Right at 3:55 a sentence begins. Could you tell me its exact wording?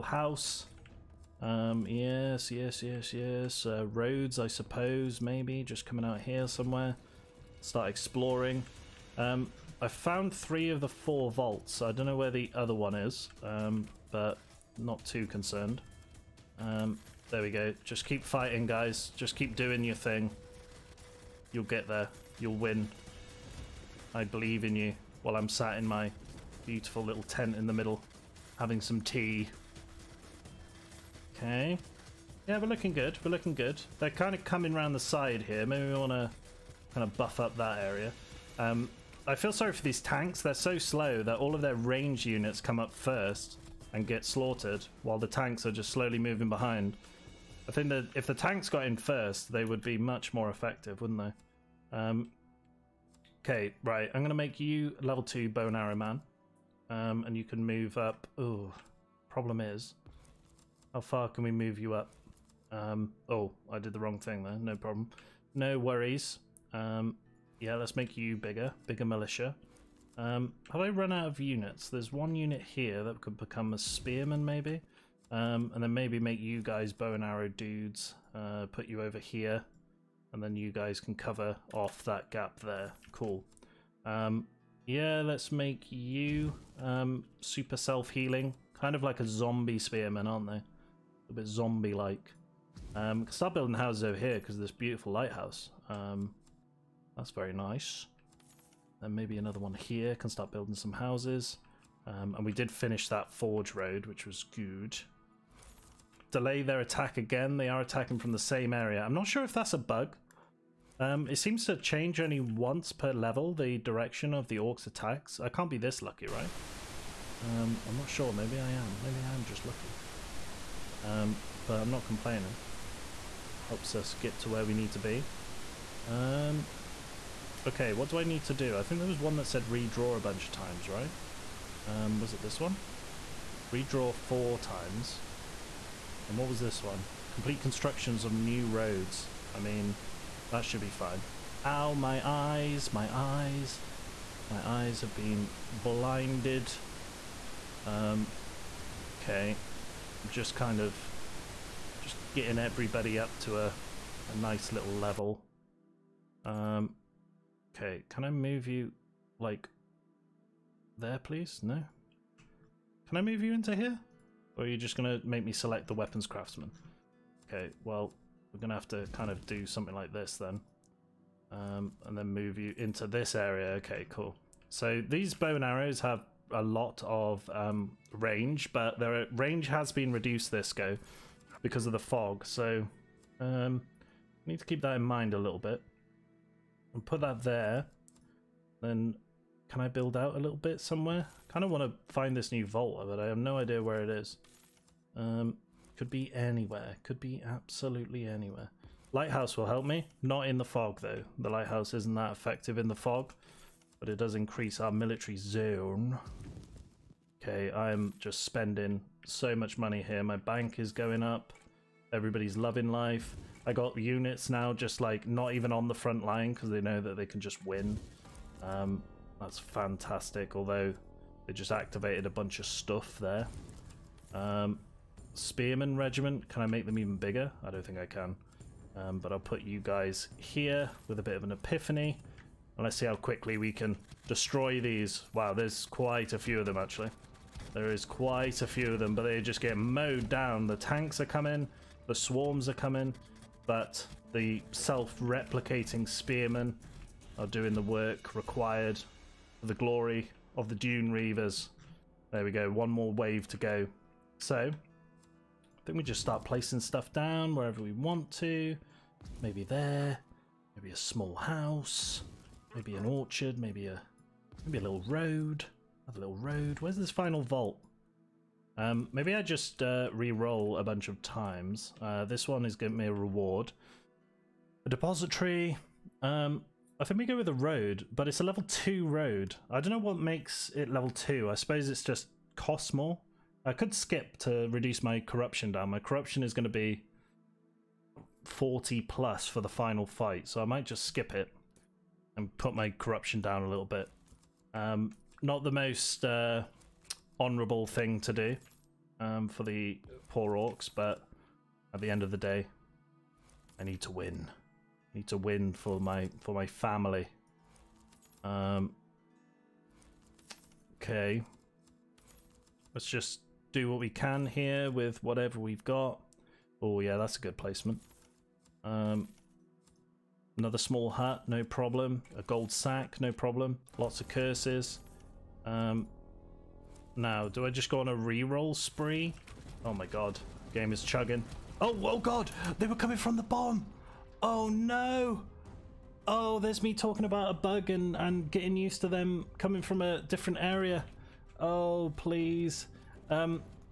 Wow, there's quite a few of them actually.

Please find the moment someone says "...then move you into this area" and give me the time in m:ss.
2:52.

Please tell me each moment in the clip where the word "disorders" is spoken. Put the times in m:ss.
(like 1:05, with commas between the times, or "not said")
not said.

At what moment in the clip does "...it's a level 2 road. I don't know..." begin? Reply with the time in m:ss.
4:38.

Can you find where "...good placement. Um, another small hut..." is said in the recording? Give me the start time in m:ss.
5:17.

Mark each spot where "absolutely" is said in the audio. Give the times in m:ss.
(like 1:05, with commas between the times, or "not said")
3:17.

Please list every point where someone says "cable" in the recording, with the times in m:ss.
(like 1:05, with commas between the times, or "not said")
not said.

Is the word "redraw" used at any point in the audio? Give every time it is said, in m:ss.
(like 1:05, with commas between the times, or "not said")
2:09, 2:13.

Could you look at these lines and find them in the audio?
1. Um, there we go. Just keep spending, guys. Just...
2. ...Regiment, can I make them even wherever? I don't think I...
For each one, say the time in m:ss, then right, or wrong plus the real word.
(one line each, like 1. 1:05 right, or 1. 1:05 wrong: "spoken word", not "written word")
1. 0:16 wrong: "fighting", not "spending"
2. 3:45 wrong: "bigger", not "wherever".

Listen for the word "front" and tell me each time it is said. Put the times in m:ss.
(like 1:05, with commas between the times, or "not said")
3:35.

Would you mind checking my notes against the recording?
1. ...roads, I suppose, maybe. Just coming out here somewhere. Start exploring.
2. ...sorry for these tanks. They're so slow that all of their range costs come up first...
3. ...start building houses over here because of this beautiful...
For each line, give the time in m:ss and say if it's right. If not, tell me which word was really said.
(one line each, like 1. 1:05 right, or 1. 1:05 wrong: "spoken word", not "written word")
1. 0:03 right
2. 0:39 wrong: "units", not "costs"
3. 1:33 right.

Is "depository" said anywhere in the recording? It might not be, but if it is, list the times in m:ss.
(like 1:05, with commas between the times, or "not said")
4:34.